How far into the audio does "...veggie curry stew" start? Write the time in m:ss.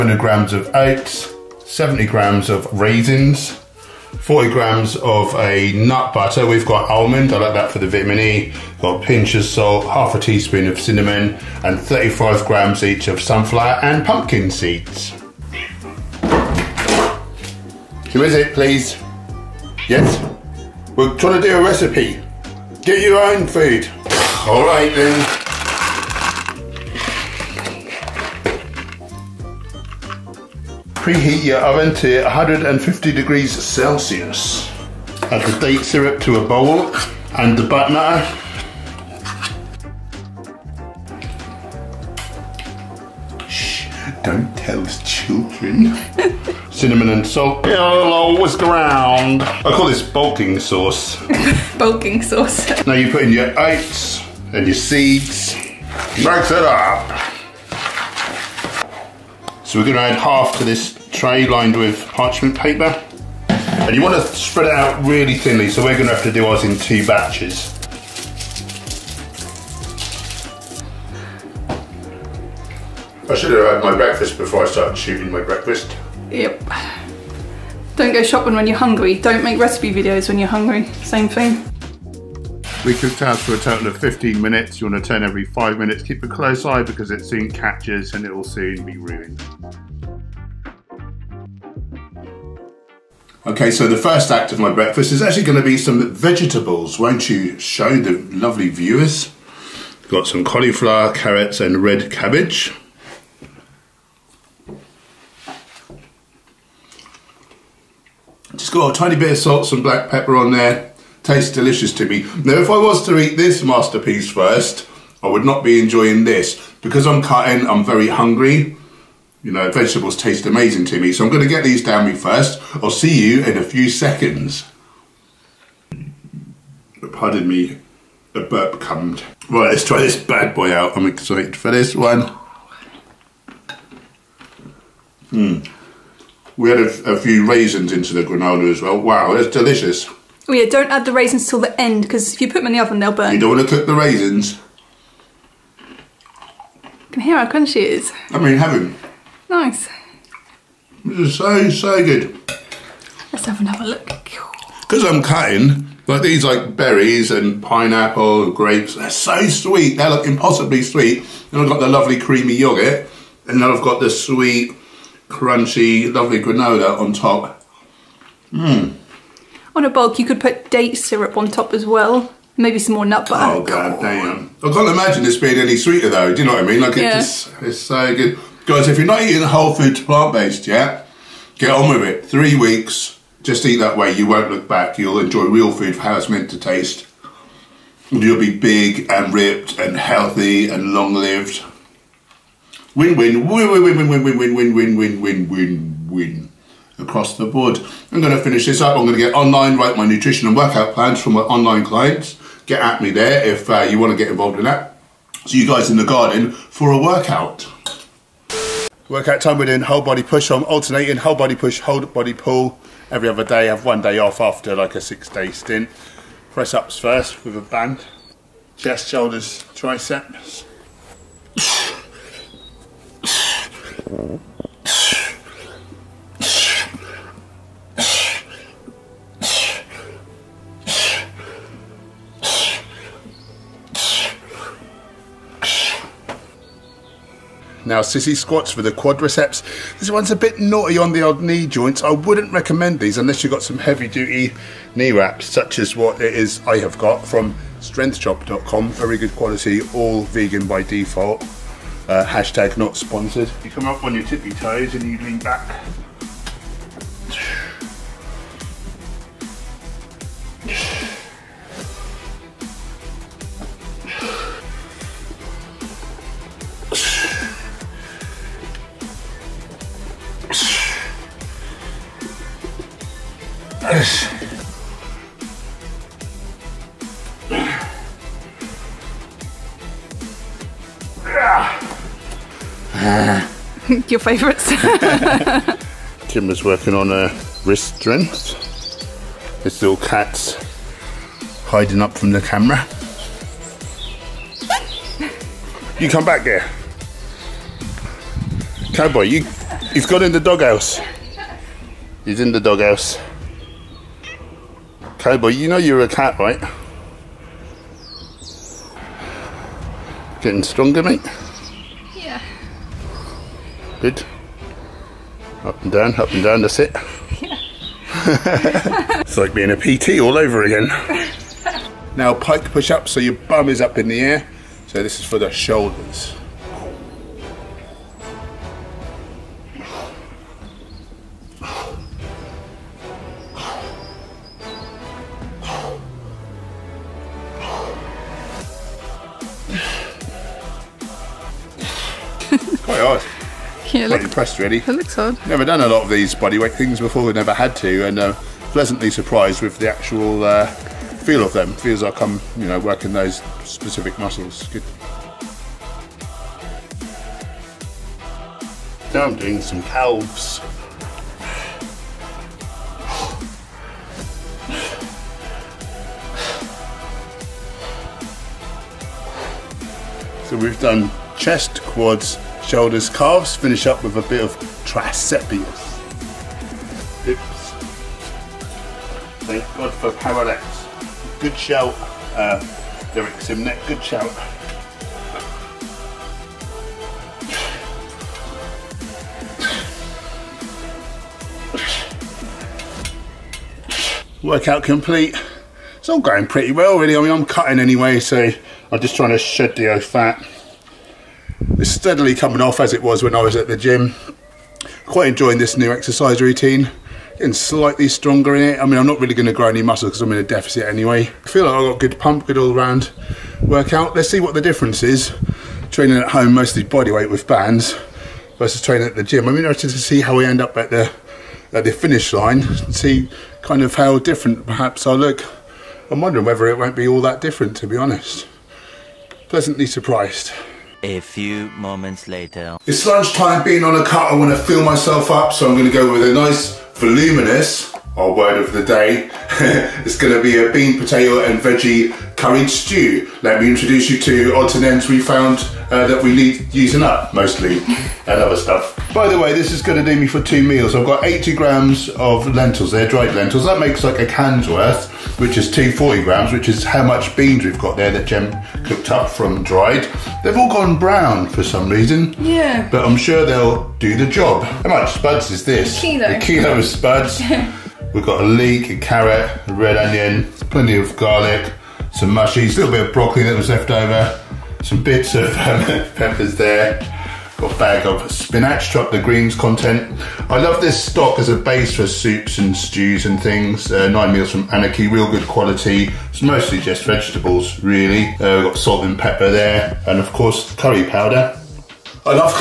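7:21.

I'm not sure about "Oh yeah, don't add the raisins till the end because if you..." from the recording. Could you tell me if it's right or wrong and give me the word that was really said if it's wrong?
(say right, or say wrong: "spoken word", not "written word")
right.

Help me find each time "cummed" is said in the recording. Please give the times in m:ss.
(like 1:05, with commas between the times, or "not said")
2:08.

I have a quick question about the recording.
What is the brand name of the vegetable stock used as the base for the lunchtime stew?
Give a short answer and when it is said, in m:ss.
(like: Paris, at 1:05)
Nine Meals from Anarchy, at 8:04.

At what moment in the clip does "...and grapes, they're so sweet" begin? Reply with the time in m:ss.
2:38.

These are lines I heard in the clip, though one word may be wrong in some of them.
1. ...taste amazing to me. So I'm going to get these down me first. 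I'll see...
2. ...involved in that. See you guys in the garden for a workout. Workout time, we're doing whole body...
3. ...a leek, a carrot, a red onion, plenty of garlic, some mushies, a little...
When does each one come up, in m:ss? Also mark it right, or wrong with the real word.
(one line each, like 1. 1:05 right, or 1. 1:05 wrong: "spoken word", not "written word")
1. 2:00 right
2. 3:24 right
3. 7:48 right.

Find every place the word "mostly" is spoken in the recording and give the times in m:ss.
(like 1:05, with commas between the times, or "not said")
6:56, 7:27, 8:06.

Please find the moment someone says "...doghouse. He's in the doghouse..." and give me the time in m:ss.
5:00.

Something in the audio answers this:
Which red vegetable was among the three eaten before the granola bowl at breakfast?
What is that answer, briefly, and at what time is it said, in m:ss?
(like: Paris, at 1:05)
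Red cabbage, at 1:41.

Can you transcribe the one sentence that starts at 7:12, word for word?
It's lunchtime being on a cut.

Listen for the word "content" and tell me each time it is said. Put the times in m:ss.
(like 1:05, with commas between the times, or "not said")
7:59.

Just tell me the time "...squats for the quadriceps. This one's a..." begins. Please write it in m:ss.
3:58.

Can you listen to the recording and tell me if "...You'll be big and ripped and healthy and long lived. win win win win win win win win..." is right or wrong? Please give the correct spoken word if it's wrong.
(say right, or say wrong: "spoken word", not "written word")
right.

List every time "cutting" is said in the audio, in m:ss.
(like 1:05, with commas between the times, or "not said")
1:57, 2:35, 6:37.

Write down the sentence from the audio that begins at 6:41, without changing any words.
It's steadily coming off as it was when I was at the gym.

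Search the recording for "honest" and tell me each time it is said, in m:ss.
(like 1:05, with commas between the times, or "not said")
7:07.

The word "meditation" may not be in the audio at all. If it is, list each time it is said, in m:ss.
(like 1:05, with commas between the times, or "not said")
not said.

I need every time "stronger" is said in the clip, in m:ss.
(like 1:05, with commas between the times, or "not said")
5:10, 6:48.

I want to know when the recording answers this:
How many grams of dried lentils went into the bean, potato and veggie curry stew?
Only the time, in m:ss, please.
7:31.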